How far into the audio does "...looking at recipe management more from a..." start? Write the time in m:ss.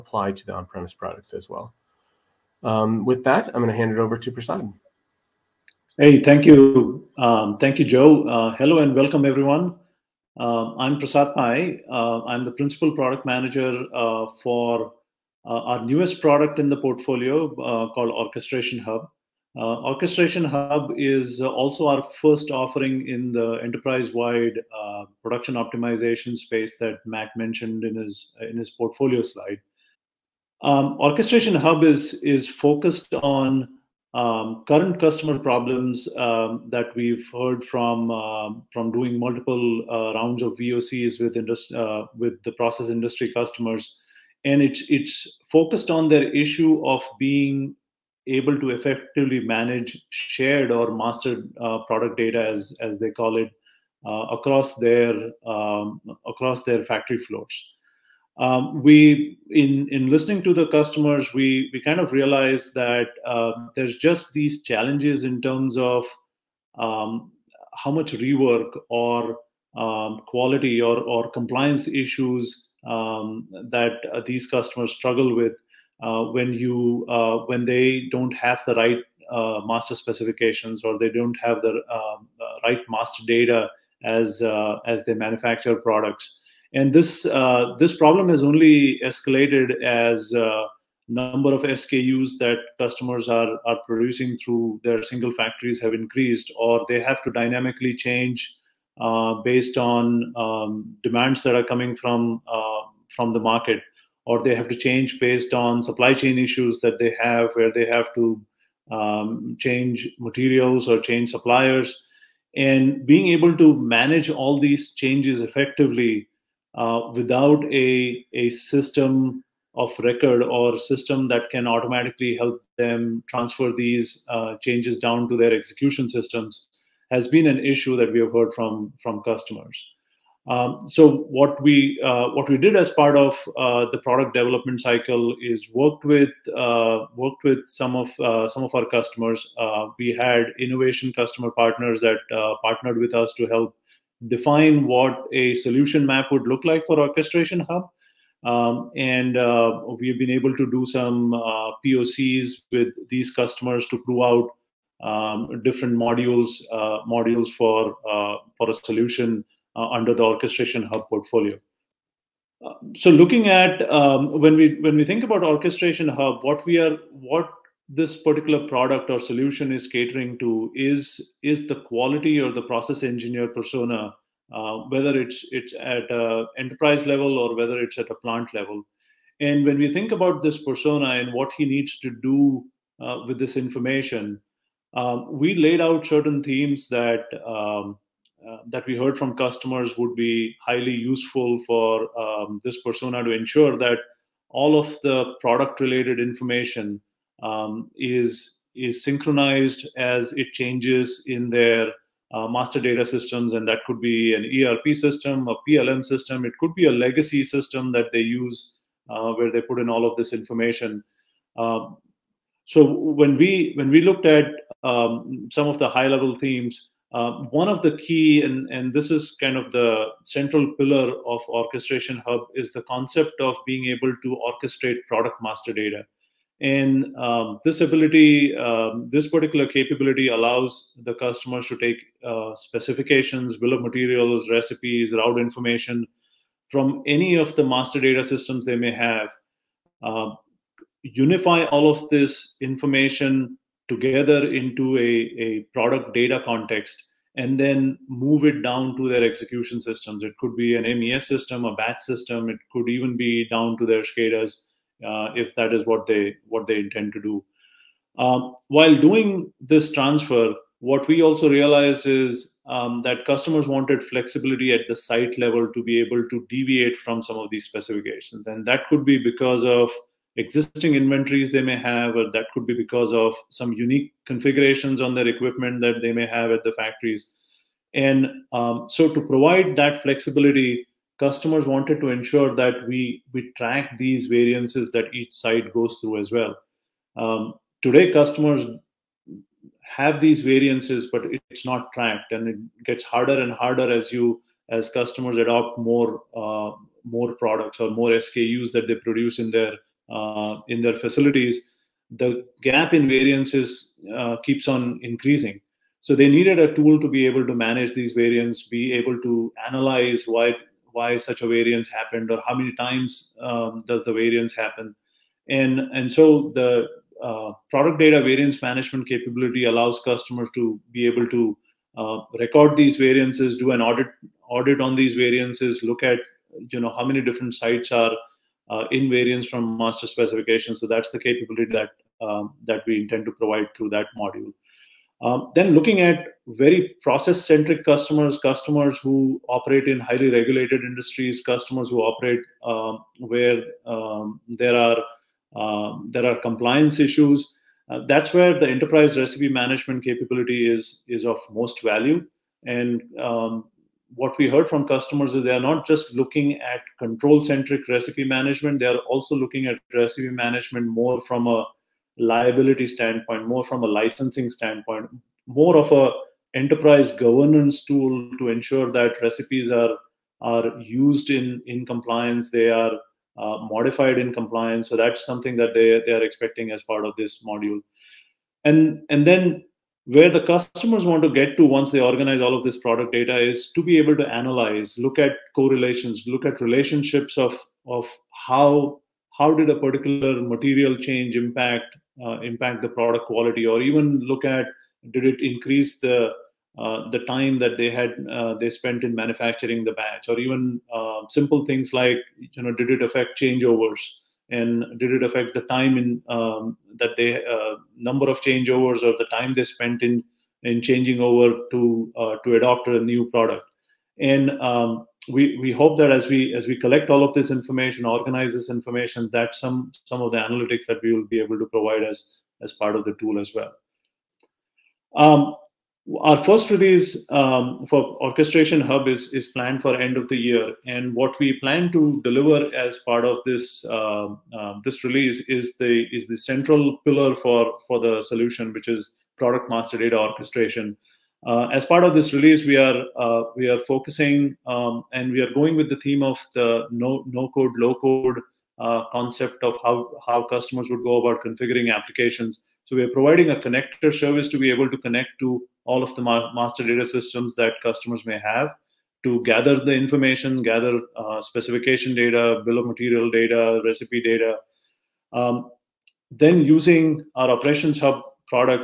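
5:59.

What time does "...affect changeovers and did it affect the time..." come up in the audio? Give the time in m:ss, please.
6:43.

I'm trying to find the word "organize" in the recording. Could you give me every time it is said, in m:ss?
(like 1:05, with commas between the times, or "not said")
6:22, 6:58.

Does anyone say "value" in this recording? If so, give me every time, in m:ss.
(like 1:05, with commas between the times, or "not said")
5:51.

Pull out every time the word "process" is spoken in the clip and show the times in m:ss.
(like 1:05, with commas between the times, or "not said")
0:42, 2:52, 5:37.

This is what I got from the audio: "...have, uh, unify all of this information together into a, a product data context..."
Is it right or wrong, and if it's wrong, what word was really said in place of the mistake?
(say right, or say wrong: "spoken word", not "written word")
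right.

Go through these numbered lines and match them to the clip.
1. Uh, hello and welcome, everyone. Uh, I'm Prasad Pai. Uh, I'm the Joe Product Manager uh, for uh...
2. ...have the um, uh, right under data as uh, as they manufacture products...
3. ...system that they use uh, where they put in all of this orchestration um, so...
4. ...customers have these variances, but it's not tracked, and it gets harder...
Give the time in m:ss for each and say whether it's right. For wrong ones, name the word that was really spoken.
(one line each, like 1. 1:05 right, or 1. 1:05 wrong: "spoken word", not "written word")
1. 0:08 wrong: "Principal", not "Joe"
2. 1:21 wrong: "master", not "under"
3. 3:27 wrong: "information", not "orchestration"
4. 4:48 right.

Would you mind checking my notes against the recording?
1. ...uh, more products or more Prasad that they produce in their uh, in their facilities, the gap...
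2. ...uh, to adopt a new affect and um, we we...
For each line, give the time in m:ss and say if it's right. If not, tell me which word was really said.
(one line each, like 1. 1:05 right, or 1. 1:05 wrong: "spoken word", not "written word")
1. 4:56 wrong: "SKUs", not "Prasad"
2. 6:52 wrong: "product", not "affect".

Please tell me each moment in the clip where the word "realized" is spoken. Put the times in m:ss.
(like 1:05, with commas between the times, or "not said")
1:02, 4:21.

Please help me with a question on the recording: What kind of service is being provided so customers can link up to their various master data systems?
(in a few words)
connector service.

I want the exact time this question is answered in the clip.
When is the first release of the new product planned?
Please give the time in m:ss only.
7:10.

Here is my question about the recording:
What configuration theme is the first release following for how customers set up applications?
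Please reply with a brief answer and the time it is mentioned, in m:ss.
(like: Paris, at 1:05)
no code low code, at 7:26.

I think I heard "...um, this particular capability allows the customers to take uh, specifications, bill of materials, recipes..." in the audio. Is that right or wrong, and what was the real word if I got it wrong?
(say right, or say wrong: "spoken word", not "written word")
right.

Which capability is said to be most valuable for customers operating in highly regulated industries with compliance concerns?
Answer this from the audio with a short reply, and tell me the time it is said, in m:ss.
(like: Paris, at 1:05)
enterprise recipe management, at 5:48.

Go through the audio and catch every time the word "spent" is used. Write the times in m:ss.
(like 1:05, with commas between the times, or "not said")
6:38, 6:49.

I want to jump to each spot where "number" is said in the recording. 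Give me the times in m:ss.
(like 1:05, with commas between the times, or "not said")
1:31, 6:47.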